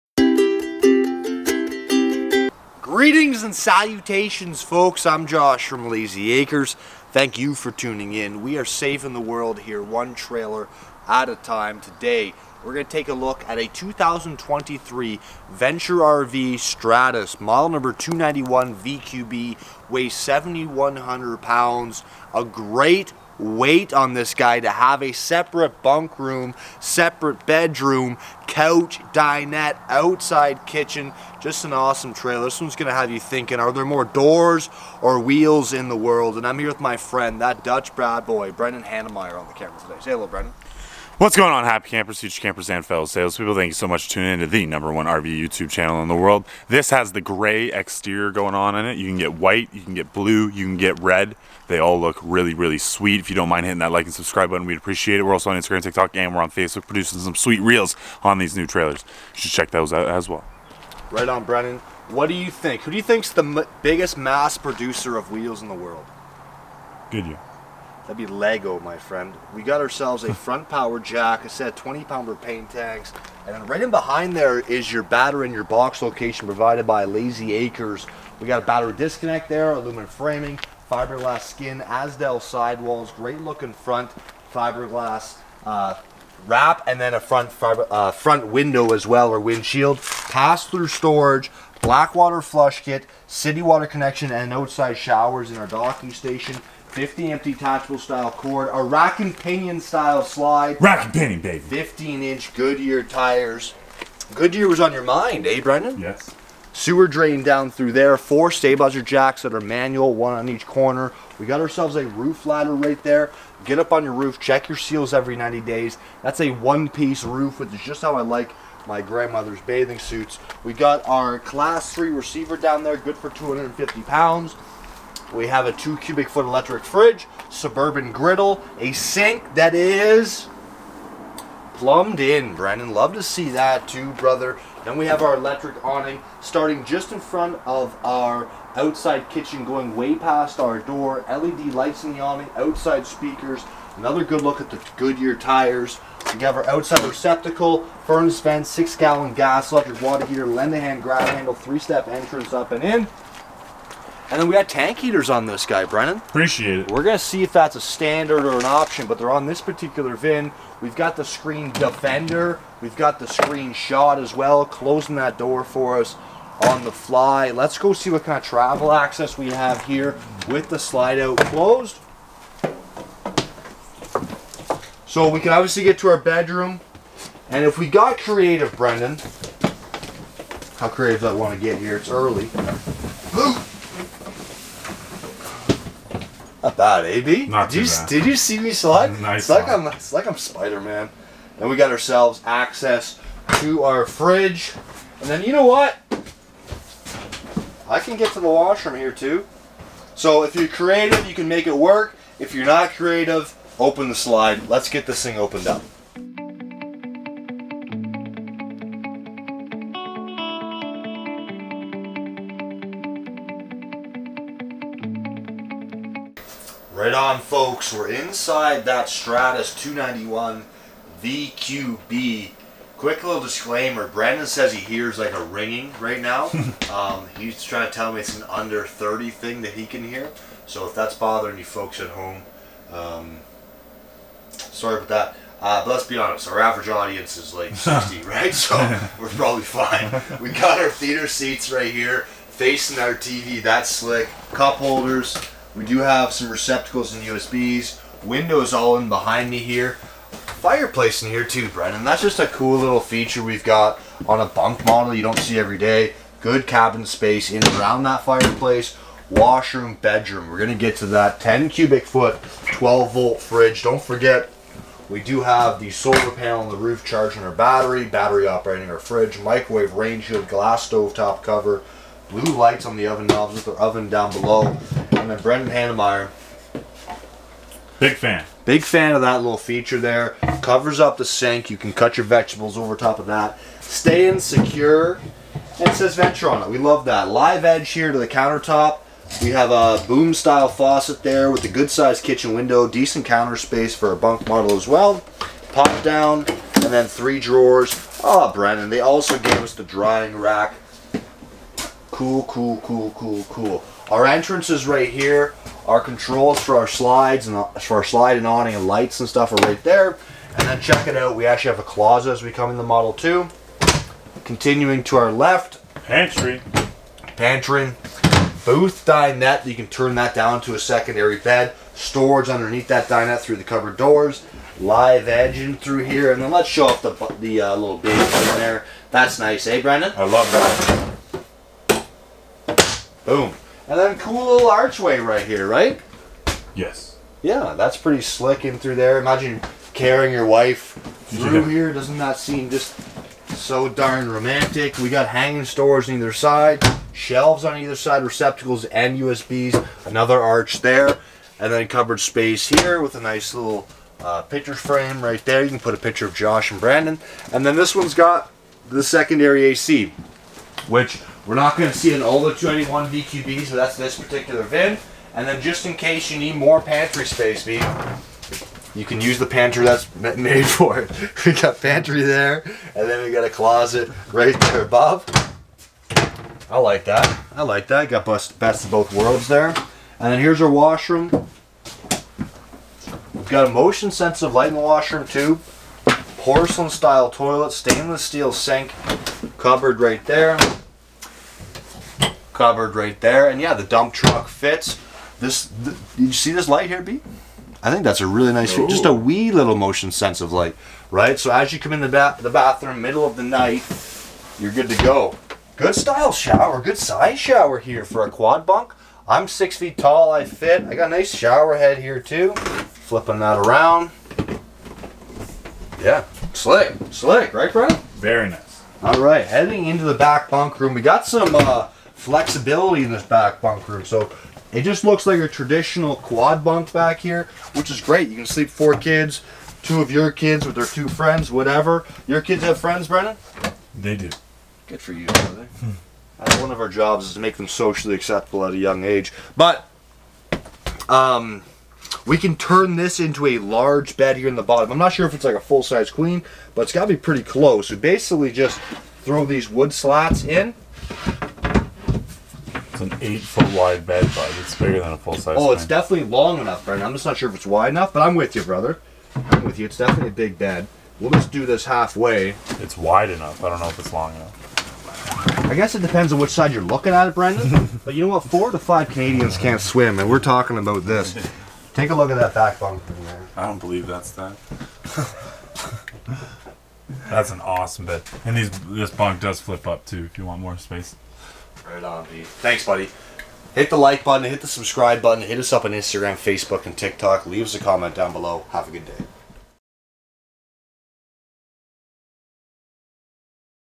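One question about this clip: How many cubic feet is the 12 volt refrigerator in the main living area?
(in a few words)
10 cubic foot.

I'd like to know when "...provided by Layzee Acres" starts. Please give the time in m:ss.
1:16.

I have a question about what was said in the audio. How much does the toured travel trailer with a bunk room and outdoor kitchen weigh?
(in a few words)
7,100 pounds.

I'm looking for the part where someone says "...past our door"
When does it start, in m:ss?
2:20.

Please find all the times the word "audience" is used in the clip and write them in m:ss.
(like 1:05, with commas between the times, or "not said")
3:56.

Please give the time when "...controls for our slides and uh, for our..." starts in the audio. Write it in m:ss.
5:06.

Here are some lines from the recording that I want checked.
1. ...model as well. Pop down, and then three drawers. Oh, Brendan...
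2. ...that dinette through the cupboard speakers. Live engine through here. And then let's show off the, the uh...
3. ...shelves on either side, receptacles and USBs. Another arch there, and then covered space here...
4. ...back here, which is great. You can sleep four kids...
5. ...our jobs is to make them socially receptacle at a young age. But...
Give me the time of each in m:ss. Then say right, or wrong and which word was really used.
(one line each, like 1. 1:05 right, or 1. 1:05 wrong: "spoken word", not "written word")
1. 4:54 right
2. 5:22 wrong: "doors", not "speakers"
3. 5:47 right
4. 7:06 right
5. 7:16 wrong: "acceptable", not "receptacle".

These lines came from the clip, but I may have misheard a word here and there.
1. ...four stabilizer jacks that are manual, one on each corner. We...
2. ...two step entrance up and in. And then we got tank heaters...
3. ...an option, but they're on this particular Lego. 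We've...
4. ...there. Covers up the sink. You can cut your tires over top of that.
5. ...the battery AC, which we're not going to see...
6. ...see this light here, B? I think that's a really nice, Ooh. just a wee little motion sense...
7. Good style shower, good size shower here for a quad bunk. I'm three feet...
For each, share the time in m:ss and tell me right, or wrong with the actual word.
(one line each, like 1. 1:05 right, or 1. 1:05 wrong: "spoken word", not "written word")
1. 1:48 right
2. 2:31 wrong: "three", not "two"
3. 2:38 wrong: "VIN", not "Lego"
4. 4:39 wrong: "vegetables", not "tires"
5. 5:58 wrong: "secondary", not "battery"
6. 6:36 right
7. 6:45 wrong: "six", not "three".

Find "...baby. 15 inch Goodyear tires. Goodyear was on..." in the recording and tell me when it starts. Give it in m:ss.
1:41.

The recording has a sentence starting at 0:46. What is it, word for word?
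This has the gray exterior going on in it.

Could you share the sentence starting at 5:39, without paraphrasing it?
Imagine carrying your wife through here.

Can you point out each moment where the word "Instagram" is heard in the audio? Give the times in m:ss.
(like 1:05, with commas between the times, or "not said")
0:55, 8:05.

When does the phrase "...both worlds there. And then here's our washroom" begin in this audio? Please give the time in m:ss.
6:18.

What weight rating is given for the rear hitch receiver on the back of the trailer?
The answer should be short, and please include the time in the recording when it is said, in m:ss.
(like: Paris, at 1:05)
250 pounds, at 2:03.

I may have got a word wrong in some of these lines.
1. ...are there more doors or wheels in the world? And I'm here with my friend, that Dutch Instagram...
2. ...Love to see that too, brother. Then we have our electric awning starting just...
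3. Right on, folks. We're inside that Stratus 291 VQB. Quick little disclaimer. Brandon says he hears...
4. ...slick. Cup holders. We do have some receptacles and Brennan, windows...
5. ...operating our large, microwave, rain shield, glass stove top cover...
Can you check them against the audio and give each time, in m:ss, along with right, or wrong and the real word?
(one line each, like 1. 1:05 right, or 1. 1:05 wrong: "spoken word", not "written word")
1. 0:33 wrong: "Brad", not "Instagram"
2. 2:12 right
3. 3:36 right
4. 4:03 wrong: "USBs", not "Brennan"
5. 4:28 wrong: "fridge", not "large".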